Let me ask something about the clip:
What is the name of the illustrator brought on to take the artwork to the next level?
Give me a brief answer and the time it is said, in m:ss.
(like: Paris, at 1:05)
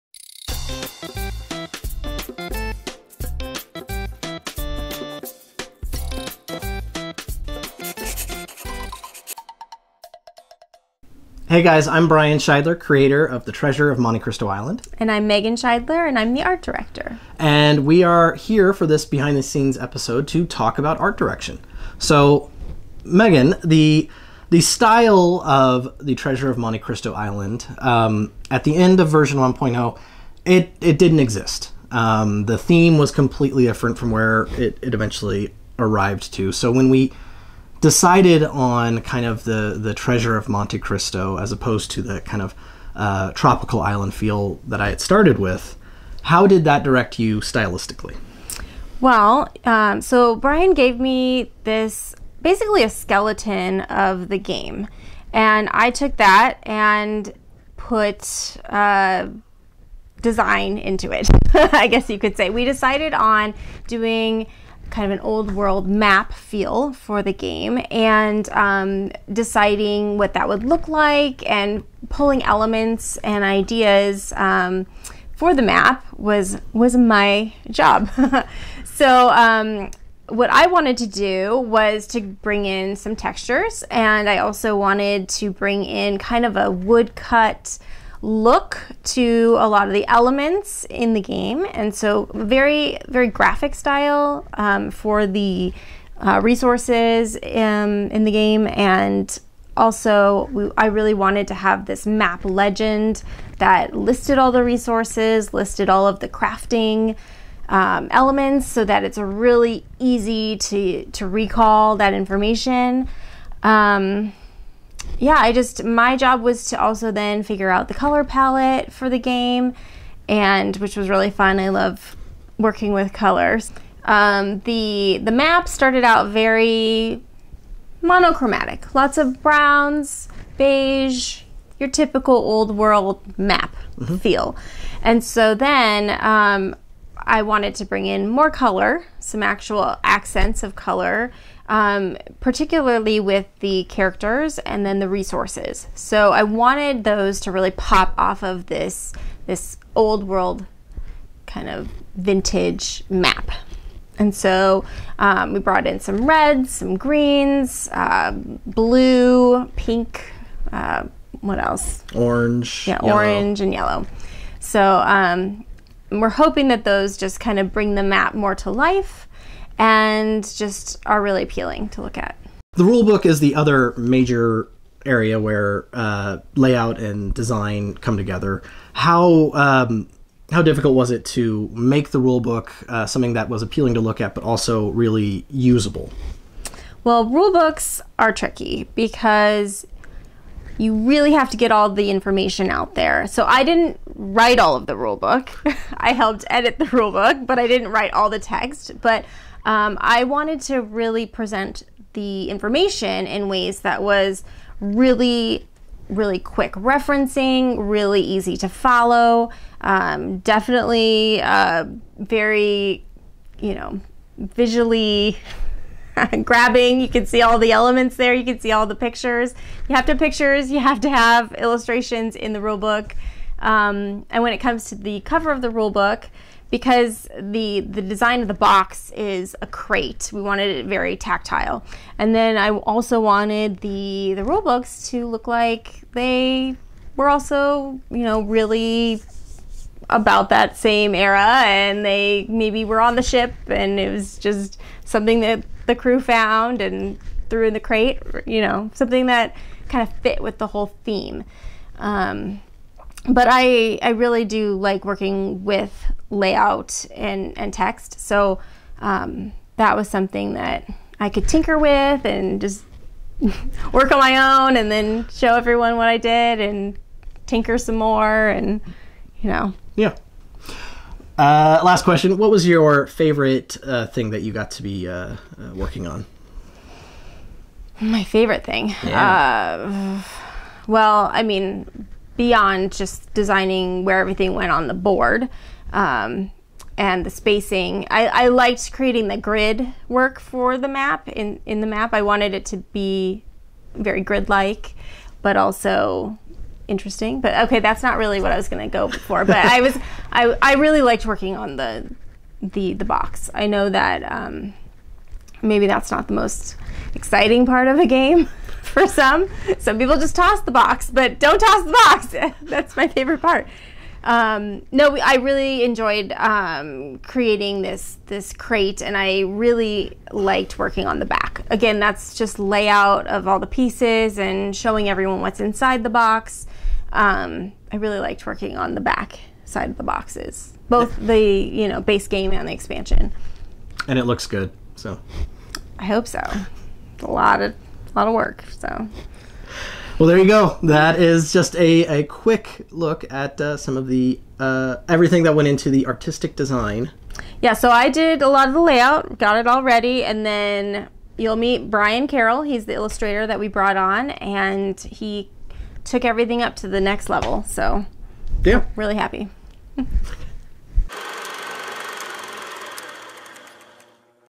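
Brian Carroll, at 5:51.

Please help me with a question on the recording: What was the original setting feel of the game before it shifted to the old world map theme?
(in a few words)
Tropical island.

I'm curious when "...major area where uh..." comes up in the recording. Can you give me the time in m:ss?
2:53.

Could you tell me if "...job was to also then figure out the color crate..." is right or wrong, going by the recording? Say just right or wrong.
wrong.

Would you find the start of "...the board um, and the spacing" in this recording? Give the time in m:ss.
4:44.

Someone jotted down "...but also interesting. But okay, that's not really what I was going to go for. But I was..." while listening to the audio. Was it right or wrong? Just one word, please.
right.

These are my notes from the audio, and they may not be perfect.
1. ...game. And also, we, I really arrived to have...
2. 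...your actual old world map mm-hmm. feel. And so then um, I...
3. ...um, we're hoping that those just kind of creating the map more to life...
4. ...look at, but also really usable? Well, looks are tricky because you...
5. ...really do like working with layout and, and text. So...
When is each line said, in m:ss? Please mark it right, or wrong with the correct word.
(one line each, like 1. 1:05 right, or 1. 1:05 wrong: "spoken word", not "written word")
1. 1:38 wrong: "wanted", not "arrived"
2. 2:11 wrong: "typical", not "actual"
3. 2:45 wrong: "bring", not "creating"
4. 3:04 wrong: "rulebooks", not "looks"
5. 4:14 right.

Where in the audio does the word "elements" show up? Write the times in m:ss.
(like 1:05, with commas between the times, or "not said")
1:12, 1:30, 1:48, 3:37.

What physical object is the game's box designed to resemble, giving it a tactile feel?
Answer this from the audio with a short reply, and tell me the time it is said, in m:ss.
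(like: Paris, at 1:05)
A crate, at 3:49.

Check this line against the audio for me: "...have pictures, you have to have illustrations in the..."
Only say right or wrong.
right.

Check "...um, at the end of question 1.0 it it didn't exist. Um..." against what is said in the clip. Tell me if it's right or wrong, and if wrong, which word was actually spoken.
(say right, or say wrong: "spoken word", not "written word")
wrong: "version", not "question".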